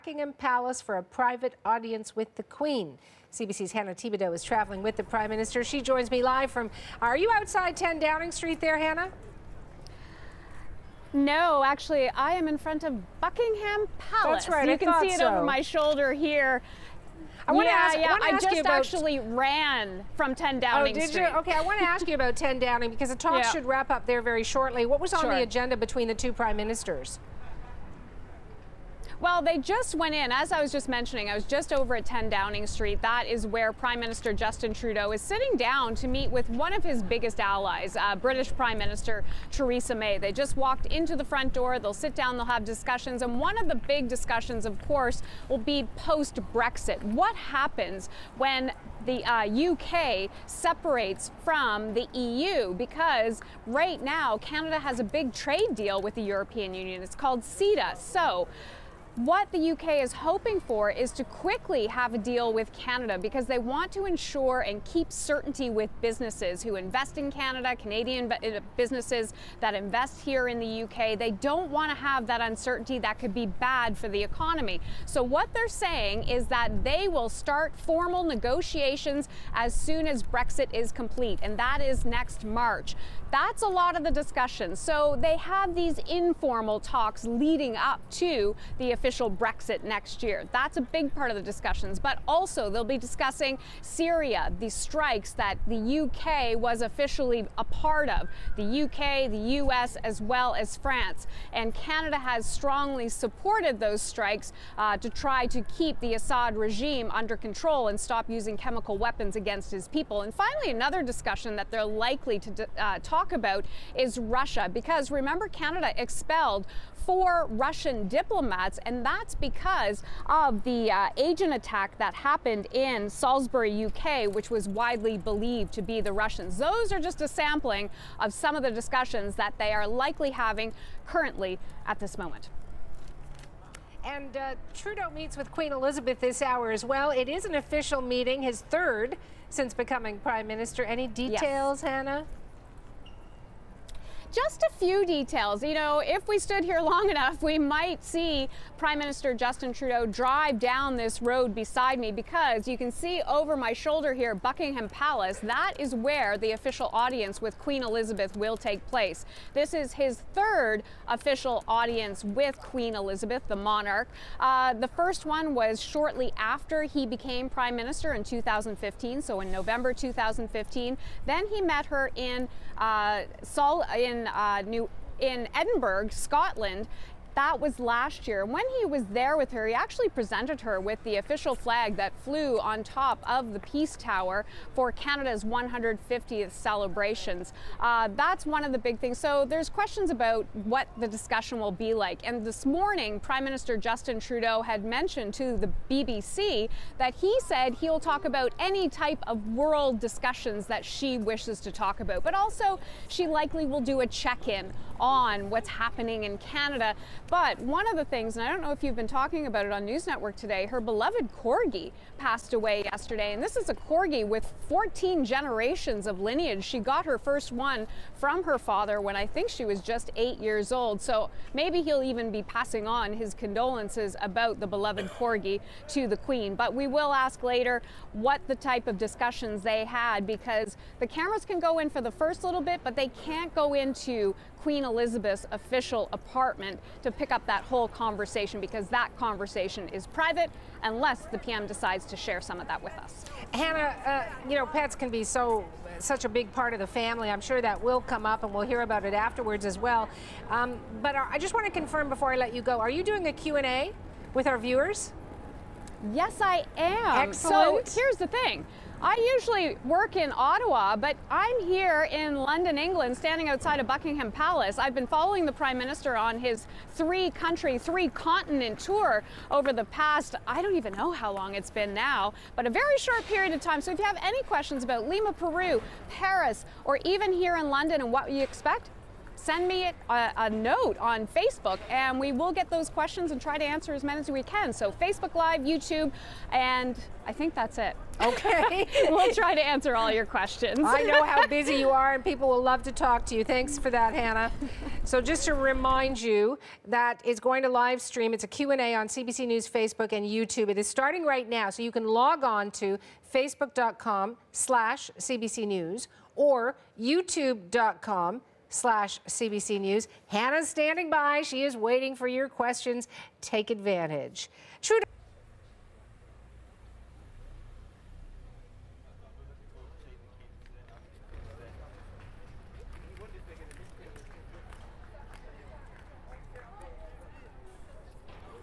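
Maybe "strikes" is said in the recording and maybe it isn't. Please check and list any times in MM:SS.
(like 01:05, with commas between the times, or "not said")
01:34, 01:43.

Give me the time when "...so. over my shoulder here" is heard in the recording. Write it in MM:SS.
00:15.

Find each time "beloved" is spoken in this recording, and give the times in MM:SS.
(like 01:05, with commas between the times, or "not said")
03:30, 03:44.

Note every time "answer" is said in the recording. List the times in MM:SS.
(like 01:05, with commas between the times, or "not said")
04:43, 04:49.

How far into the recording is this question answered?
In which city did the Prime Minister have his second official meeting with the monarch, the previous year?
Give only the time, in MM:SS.
02:55.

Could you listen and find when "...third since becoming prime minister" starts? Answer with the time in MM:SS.
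02:18.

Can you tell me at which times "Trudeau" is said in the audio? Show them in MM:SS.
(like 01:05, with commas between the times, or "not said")
00:34, 02:14, 02:29, 03:14.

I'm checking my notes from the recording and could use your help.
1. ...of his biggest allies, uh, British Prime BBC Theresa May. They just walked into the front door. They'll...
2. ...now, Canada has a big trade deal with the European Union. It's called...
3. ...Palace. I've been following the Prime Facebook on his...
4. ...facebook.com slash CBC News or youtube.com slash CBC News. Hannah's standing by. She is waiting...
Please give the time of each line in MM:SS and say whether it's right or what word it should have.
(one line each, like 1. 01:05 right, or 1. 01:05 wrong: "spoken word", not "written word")
1. 00:36 wrong: "Minister", not "BBC"
2. 00:53 right
3. 04:24 wrong: "Minister", not "Facebook"
4. 05:03 right.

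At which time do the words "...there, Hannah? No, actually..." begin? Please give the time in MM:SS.
00:08.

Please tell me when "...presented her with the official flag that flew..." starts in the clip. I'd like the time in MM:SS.
03:00.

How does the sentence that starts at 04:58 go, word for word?
It's a Q&A on CBC News Facebook and YouTube.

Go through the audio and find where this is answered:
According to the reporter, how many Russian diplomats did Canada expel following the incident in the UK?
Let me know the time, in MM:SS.
01:57.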